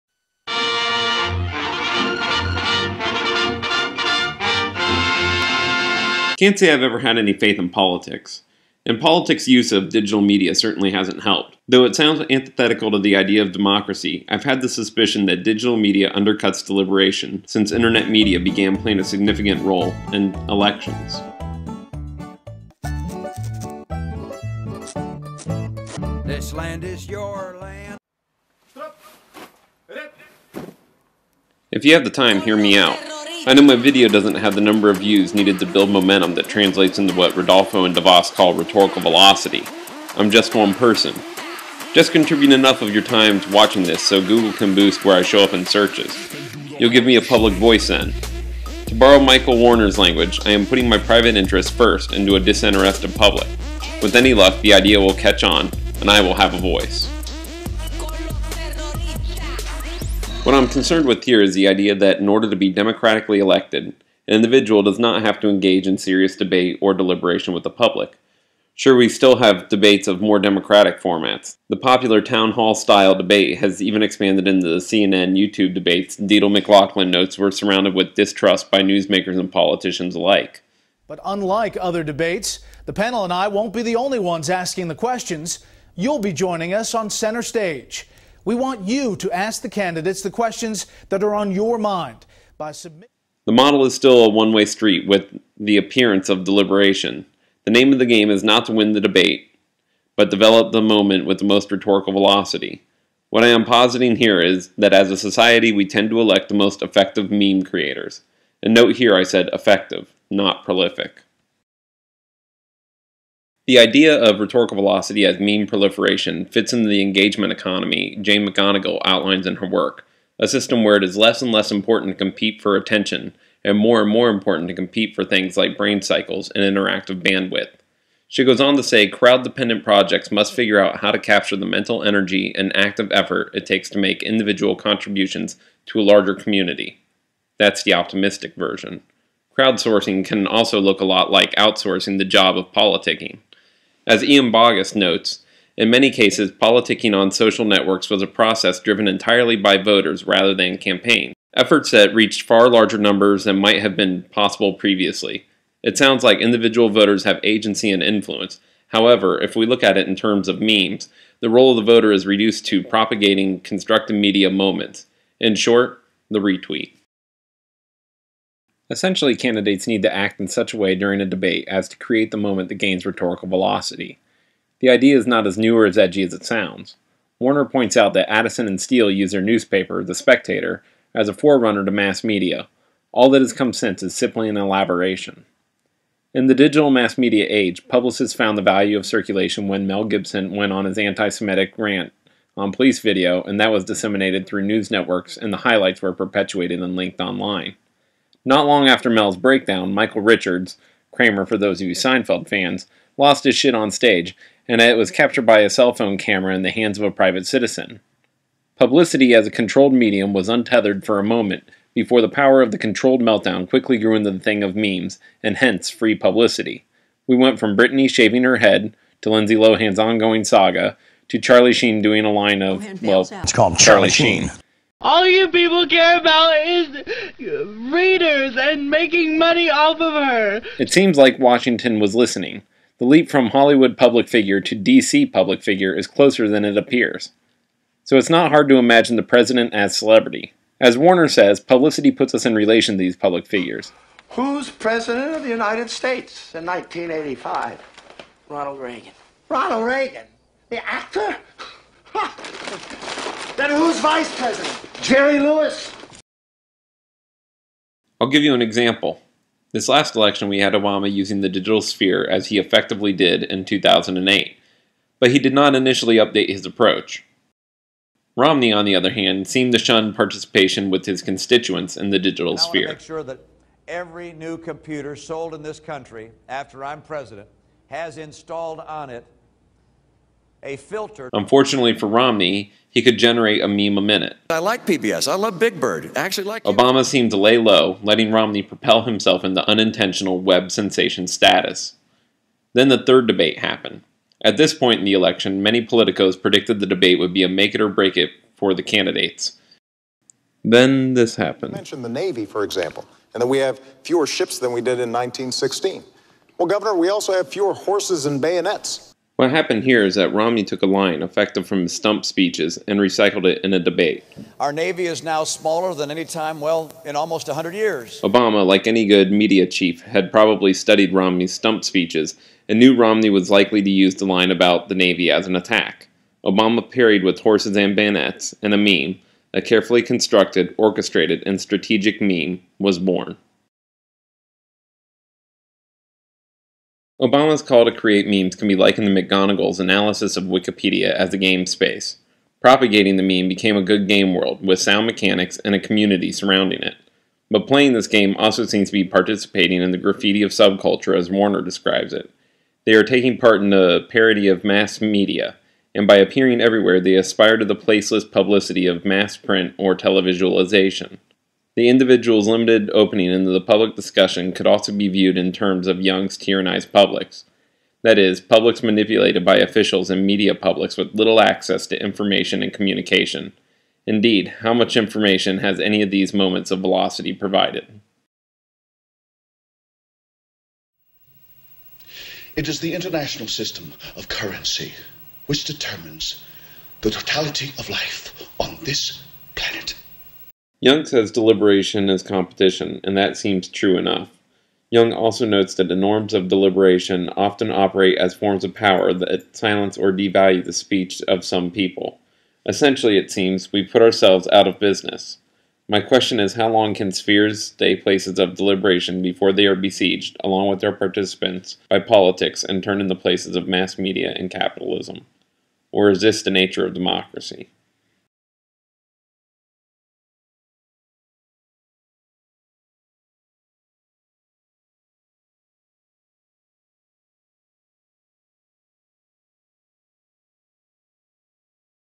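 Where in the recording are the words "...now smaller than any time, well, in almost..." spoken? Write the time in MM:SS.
05:15.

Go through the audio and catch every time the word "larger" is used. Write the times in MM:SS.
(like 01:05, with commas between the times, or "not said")
02:16, 02:32.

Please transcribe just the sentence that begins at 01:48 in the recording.
And note here I said effective, not prolific.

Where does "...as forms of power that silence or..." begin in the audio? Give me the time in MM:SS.
06:38.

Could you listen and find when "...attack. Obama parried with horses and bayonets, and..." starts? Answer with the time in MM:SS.
05:25.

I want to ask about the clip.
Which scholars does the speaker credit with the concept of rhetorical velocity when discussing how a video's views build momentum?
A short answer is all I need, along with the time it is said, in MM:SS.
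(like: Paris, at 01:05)
Ridolfo and DeVoss, at 00:37.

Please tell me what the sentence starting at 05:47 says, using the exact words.
But playing this game also seems to be participating in the graffiti of subculture as Warner describes it.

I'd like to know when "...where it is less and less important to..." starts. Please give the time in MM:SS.
02:00.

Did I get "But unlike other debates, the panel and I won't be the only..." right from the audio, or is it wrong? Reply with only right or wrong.
right.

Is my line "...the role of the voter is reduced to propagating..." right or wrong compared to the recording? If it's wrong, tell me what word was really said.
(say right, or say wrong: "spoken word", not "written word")
right.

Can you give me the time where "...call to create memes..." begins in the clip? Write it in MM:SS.
05:37.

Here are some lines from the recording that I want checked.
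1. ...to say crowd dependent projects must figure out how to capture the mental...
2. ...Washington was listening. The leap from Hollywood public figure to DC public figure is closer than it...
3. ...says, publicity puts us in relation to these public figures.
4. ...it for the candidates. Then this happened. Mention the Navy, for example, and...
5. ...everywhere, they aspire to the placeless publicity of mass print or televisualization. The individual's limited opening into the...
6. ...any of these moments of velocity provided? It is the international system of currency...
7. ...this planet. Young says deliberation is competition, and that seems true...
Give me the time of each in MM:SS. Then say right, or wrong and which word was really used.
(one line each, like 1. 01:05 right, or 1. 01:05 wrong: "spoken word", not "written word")
1. 02:08 right
2. 03:51 right
3. 04:01 right
4. 04:58 right
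5. 05:56 right
6. 06:15 right
7. 06:28 right.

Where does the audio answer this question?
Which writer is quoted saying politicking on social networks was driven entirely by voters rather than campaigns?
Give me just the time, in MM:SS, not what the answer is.
02:24.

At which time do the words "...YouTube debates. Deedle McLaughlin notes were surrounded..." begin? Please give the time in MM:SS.
01:15.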